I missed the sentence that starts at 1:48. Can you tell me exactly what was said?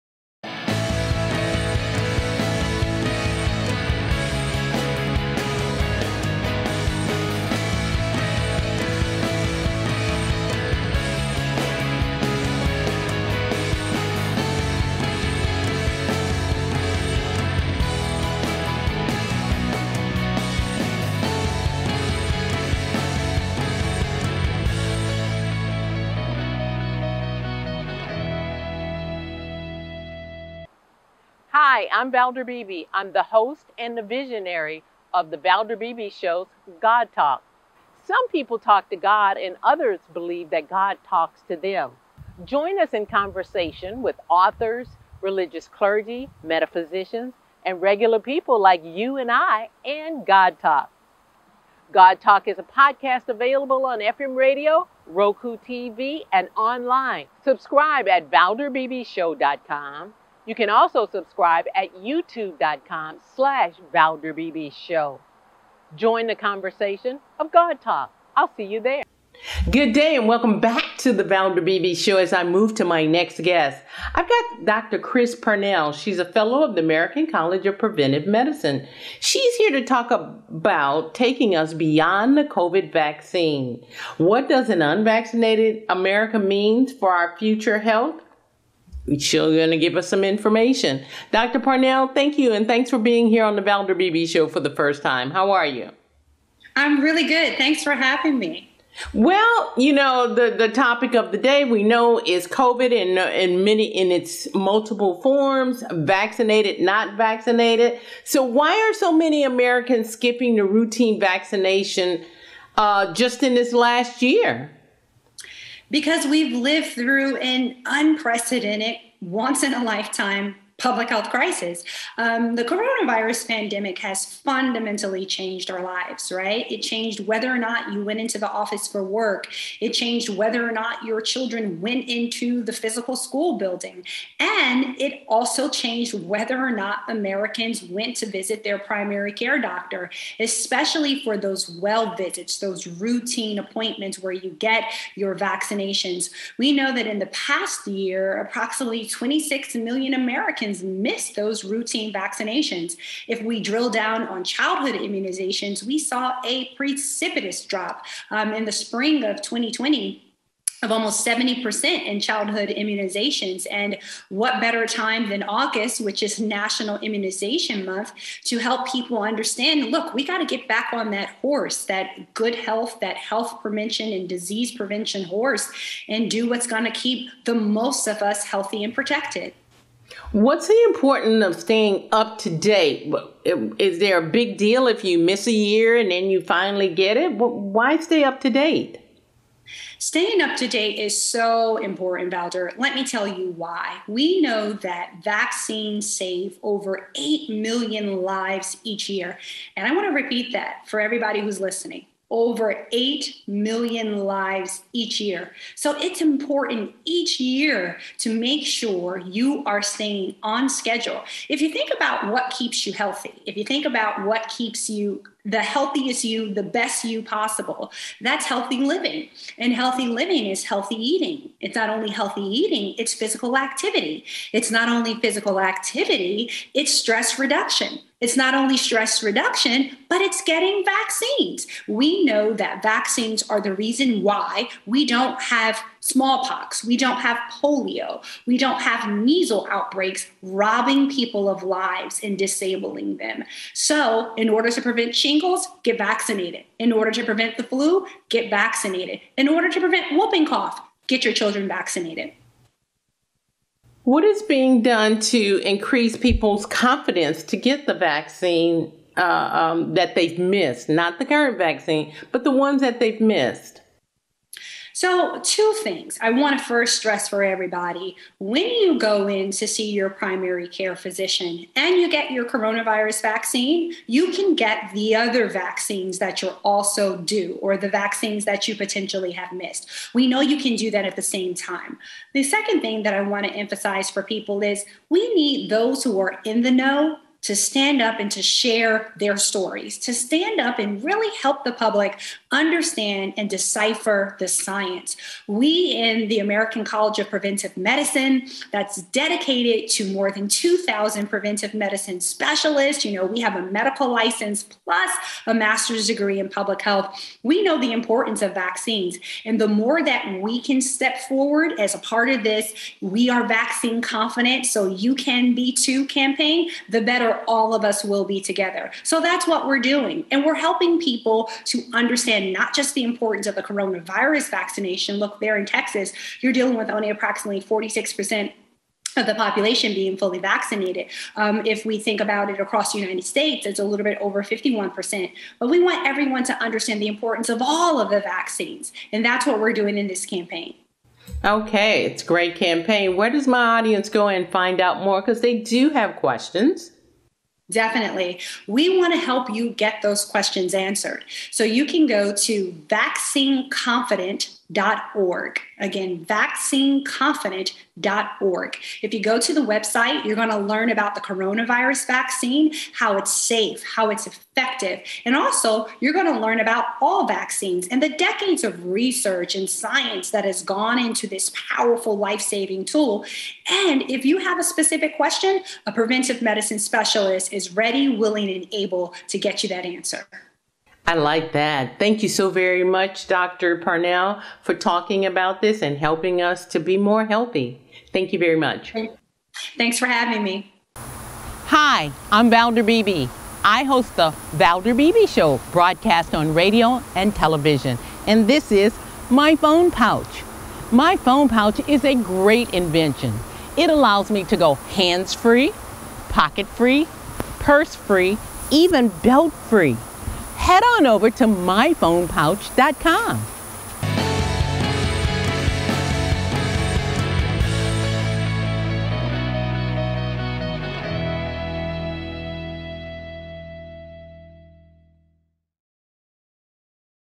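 So why are so many Americans skipping the routine vaccination uh, just in this last year?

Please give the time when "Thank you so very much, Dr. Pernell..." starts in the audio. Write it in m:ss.
6:21.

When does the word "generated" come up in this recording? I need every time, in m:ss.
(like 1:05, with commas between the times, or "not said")
not said.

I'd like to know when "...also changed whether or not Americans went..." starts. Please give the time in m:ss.
2:15.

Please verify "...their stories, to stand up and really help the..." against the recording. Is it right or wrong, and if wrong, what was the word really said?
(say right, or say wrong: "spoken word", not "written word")
right.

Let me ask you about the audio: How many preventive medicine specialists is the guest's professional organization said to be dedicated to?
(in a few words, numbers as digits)
more than 2,000.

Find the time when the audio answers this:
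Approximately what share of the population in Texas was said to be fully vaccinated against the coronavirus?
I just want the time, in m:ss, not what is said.
5:27.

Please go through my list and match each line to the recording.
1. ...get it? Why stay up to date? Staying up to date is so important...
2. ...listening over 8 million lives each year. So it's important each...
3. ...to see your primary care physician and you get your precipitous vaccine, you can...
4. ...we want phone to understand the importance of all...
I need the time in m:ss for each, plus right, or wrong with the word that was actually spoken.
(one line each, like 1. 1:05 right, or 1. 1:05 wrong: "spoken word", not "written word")
1. 3:06 right
2. 3:21 right
3. 4:29 wrong: "coronavirus", not "precipitous"
4. 5:35 wrong: "everyone", not "phone".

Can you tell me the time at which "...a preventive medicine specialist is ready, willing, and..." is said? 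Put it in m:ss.
6:15.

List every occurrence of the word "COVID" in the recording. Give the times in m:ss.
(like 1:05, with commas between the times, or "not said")
1:22, 1:42.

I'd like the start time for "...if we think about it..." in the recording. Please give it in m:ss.
5:31.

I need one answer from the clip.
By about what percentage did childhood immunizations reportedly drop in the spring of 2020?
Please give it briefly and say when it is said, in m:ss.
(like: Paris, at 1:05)
70%, at 2:41.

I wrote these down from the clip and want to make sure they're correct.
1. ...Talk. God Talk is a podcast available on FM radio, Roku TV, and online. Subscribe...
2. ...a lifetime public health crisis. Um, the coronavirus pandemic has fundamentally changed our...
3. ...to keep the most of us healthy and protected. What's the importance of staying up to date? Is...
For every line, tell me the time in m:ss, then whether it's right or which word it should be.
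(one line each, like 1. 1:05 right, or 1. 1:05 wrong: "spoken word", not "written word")
1. 0:50 right
2. 1:59 right
3. 2:56 right.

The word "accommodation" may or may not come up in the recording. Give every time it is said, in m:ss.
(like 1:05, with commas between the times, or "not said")
not said.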